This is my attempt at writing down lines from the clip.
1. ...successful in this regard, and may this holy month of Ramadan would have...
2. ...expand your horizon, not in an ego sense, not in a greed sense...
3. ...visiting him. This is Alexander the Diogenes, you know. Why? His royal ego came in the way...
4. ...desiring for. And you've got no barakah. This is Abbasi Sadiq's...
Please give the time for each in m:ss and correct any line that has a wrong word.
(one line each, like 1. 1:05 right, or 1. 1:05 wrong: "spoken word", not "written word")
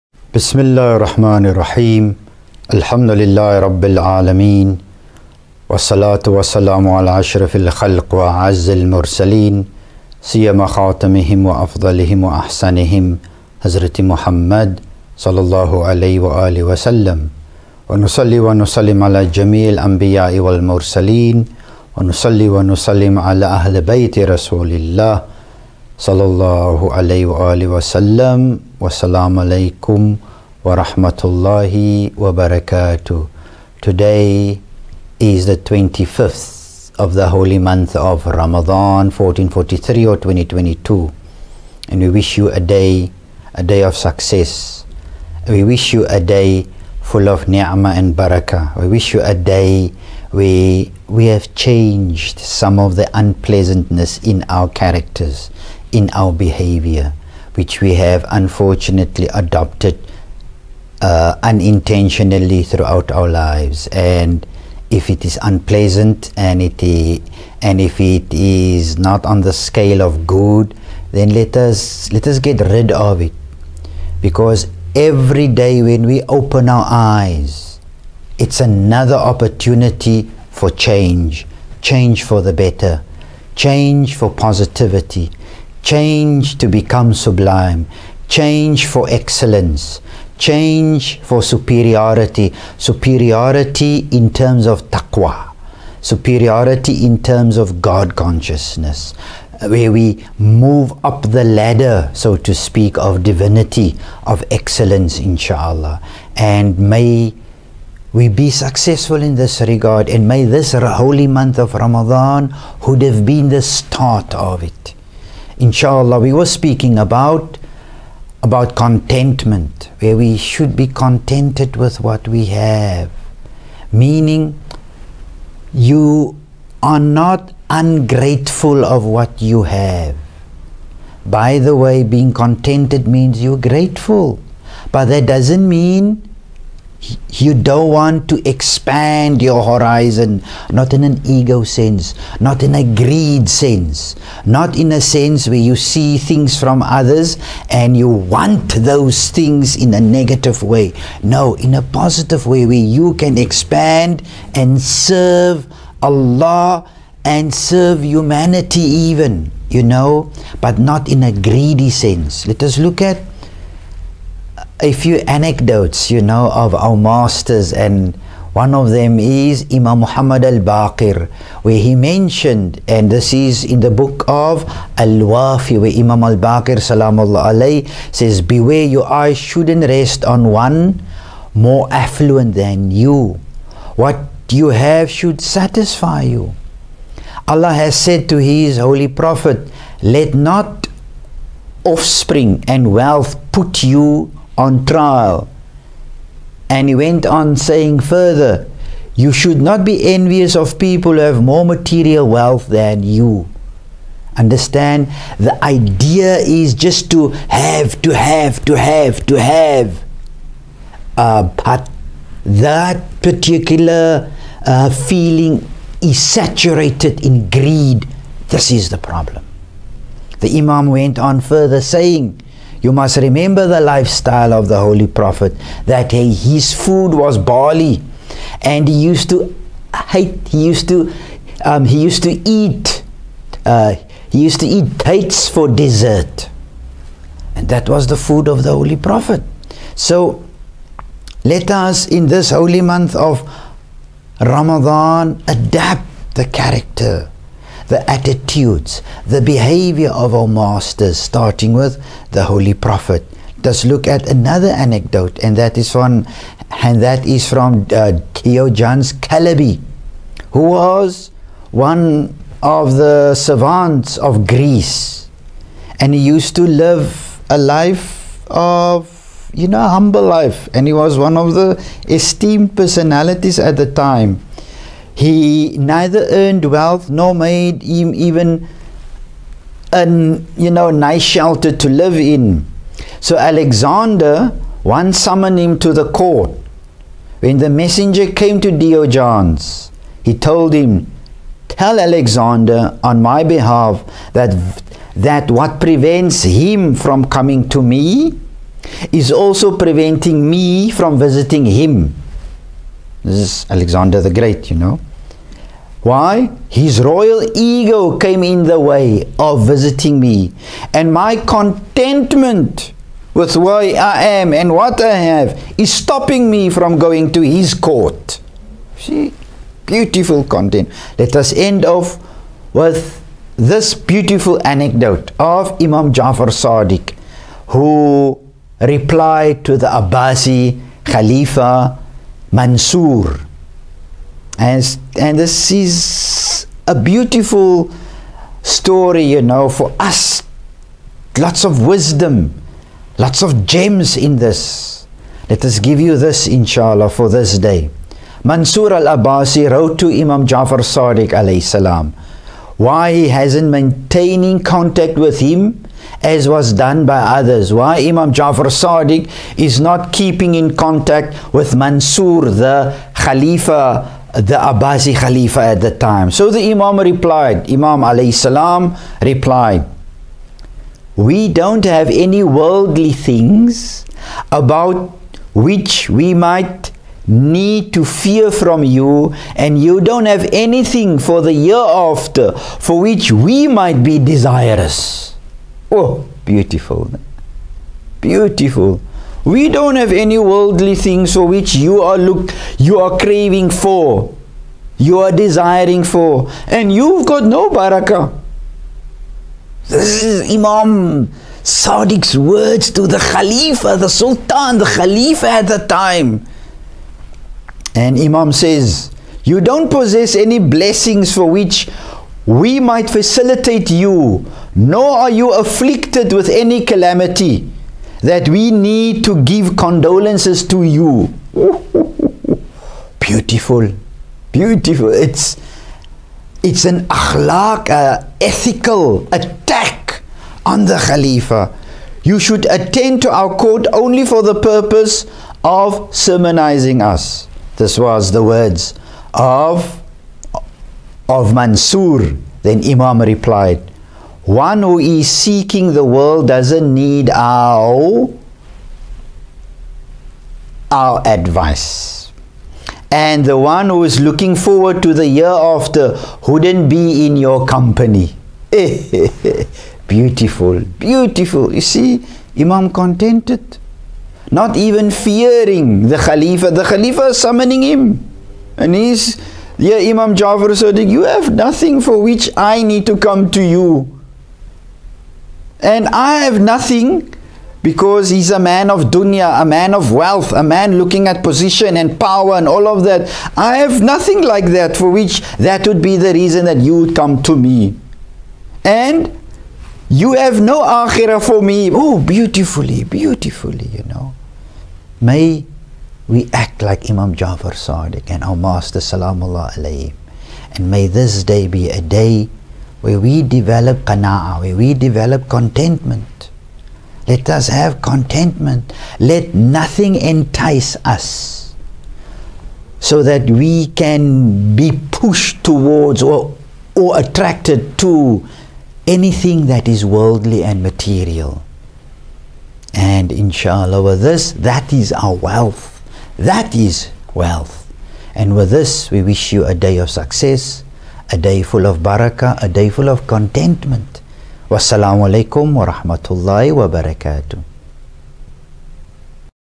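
1. 1:48 right
2. 2:18 right
3. 5:01 wrong: "Great", not "Diogenes"
4. 6:35 wrong: "Imam", not "Abbasi".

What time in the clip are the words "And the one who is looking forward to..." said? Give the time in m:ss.
7:33.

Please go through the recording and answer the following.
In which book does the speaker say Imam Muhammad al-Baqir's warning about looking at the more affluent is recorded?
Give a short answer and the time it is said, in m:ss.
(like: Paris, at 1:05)
Al Wafi, at 2:54.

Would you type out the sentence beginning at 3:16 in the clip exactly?
And he went on saying further, You should not be envious of people who have more material wealth than you.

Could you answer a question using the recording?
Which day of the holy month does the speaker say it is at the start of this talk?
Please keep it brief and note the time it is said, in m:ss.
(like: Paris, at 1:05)
25th, at 0:35.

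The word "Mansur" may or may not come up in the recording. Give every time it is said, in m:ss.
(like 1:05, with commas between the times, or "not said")
5:32, 5:48, 6:01, 7:21.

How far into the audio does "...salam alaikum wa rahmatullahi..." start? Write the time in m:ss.
0:28.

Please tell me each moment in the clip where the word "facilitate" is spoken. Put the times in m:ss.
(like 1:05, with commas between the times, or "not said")
6:53.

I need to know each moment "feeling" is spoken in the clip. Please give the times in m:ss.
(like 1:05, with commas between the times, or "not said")
3:35.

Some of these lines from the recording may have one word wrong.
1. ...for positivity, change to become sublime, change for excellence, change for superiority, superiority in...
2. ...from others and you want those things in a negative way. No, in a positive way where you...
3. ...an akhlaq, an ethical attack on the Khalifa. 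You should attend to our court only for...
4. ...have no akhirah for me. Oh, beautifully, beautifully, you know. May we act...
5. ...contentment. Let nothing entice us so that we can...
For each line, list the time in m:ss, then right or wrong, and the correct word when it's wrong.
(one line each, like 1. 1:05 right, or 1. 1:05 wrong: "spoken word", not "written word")
1. 1:24 right
2. 2:26 right
3. 7:06 right
4. 8:10 right
5. 8:28 right.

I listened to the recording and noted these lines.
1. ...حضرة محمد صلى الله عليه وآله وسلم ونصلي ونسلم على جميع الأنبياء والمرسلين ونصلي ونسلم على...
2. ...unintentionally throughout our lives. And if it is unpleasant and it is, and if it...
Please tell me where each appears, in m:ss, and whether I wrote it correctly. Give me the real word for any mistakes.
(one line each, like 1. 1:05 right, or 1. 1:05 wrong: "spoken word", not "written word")
1. 0:13 right
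2. 1:01 right.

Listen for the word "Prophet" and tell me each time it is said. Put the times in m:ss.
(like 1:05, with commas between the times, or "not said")
3:09, 3:45, 3:58, 4:12.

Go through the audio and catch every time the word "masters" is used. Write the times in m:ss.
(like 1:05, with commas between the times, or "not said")
2:46, 4:10, 8:18.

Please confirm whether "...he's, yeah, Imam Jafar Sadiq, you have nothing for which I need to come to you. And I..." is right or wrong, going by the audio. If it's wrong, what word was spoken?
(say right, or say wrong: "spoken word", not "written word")
right.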